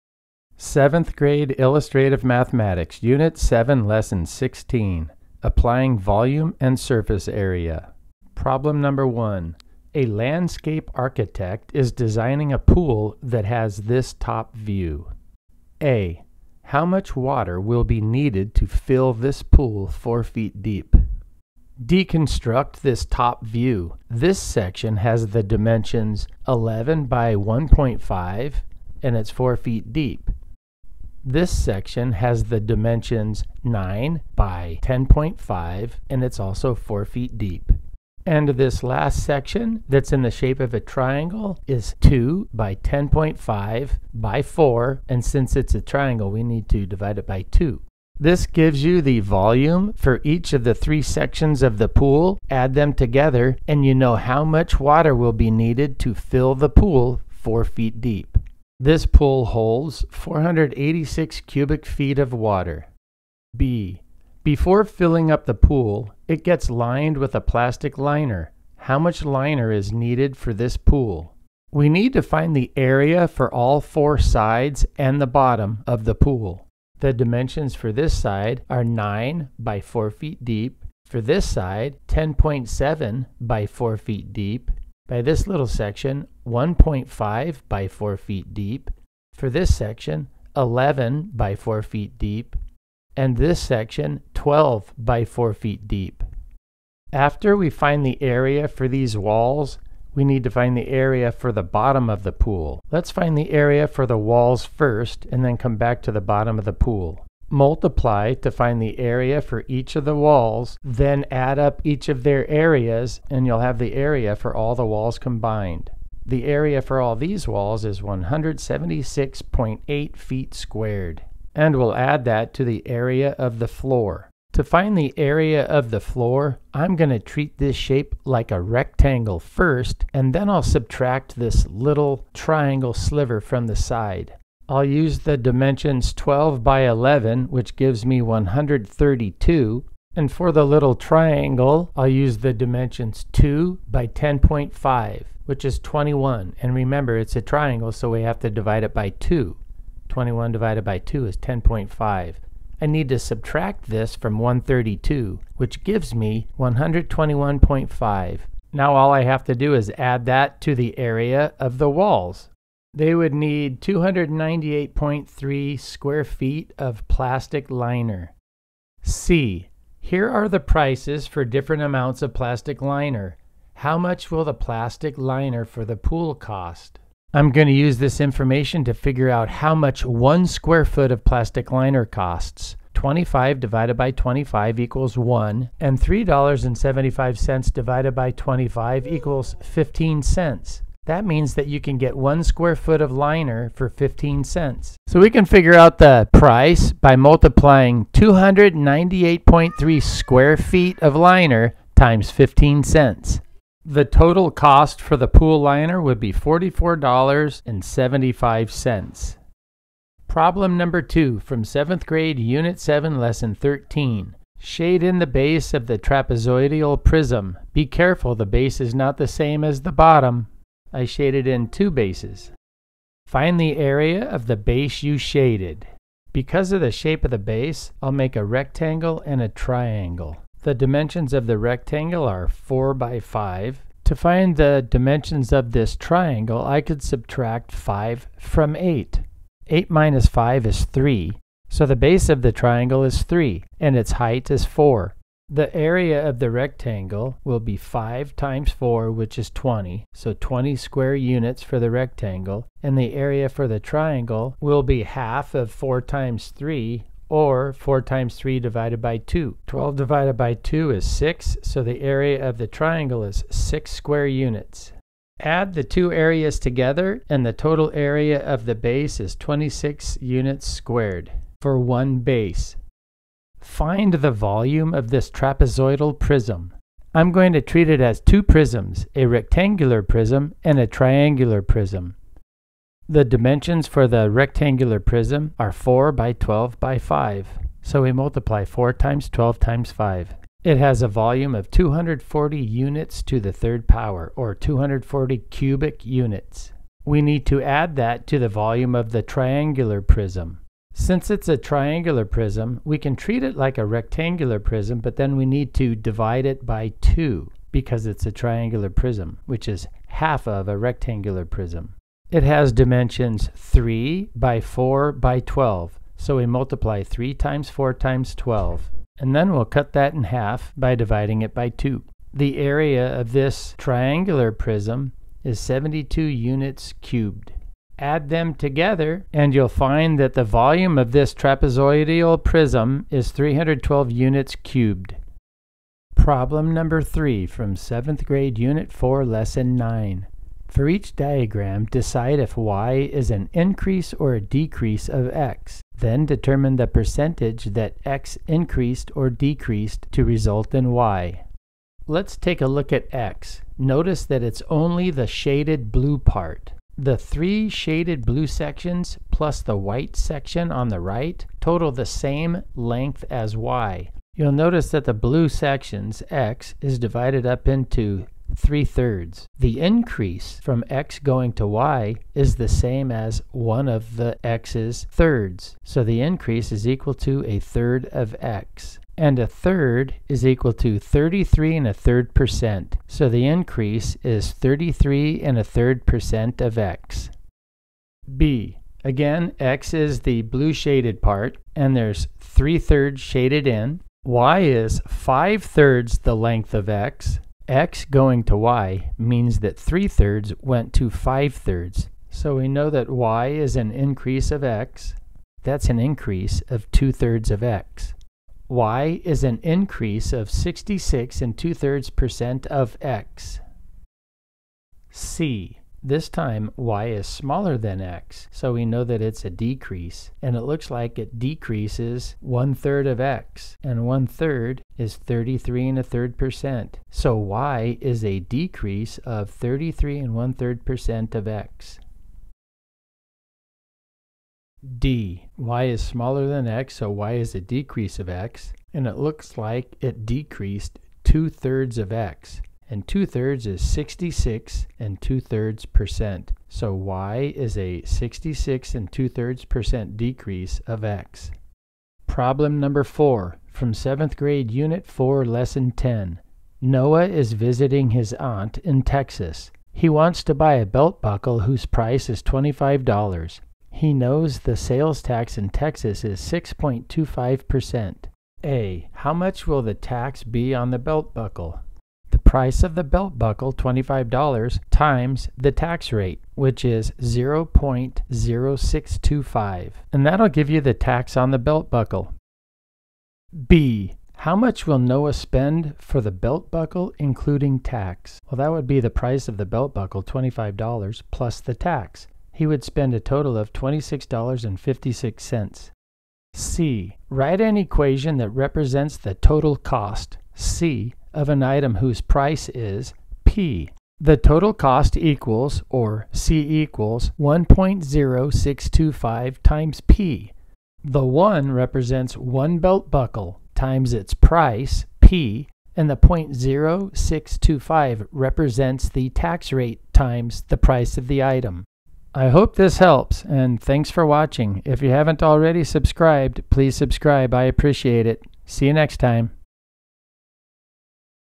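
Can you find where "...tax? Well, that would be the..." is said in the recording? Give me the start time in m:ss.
8:07.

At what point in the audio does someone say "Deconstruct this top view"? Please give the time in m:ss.
0:21.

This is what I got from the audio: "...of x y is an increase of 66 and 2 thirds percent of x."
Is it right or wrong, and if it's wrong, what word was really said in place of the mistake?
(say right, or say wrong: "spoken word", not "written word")
right.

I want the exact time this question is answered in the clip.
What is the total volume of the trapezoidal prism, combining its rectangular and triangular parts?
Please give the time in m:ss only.
5:33.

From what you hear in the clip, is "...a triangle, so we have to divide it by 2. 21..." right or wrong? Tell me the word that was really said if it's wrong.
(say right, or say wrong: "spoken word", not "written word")
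right.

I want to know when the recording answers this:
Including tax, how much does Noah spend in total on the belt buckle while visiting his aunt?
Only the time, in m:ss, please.
8:13.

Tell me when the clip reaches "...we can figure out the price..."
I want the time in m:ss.
3:15.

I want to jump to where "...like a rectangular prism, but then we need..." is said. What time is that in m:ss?
5:03.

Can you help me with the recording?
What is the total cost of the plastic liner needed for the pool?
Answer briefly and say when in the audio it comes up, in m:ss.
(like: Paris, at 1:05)
$44.75, at 3:26.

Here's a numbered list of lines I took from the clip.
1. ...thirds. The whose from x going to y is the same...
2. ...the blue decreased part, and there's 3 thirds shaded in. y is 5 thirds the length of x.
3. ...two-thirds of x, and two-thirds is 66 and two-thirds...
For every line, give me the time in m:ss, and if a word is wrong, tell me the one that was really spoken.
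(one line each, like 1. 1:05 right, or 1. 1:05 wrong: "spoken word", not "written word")
1. 6:08 wrong: "increase", not "whose"
2. 6:30 wrong: "shaded", not "decreased"
3. 7:21 right.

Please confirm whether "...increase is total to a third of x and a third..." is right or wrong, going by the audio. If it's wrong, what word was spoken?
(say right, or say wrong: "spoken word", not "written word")
wrong: "equal", not "total".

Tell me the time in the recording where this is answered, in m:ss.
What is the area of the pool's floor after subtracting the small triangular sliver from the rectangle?
2:36.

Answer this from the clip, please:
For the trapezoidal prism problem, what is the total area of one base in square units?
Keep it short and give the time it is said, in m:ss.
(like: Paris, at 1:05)
26, at 4:29.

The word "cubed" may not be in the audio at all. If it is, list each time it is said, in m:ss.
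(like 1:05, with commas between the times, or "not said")
5:27, 5:34.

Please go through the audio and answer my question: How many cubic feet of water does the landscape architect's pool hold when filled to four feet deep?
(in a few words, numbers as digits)
486.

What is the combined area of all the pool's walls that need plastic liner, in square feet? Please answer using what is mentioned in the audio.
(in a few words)
176.8.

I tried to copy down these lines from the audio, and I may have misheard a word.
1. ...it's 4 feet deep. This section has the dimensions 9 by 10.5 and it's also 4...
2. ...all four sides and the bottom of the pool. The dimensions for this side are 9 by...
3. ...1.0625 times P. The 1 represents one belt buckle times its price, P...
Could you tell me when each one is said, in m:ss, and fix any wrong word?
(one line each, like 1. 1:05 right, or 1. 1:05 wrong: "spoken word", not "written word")
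1. 0:29 right
2. 1:13 right
3. 8:27 right.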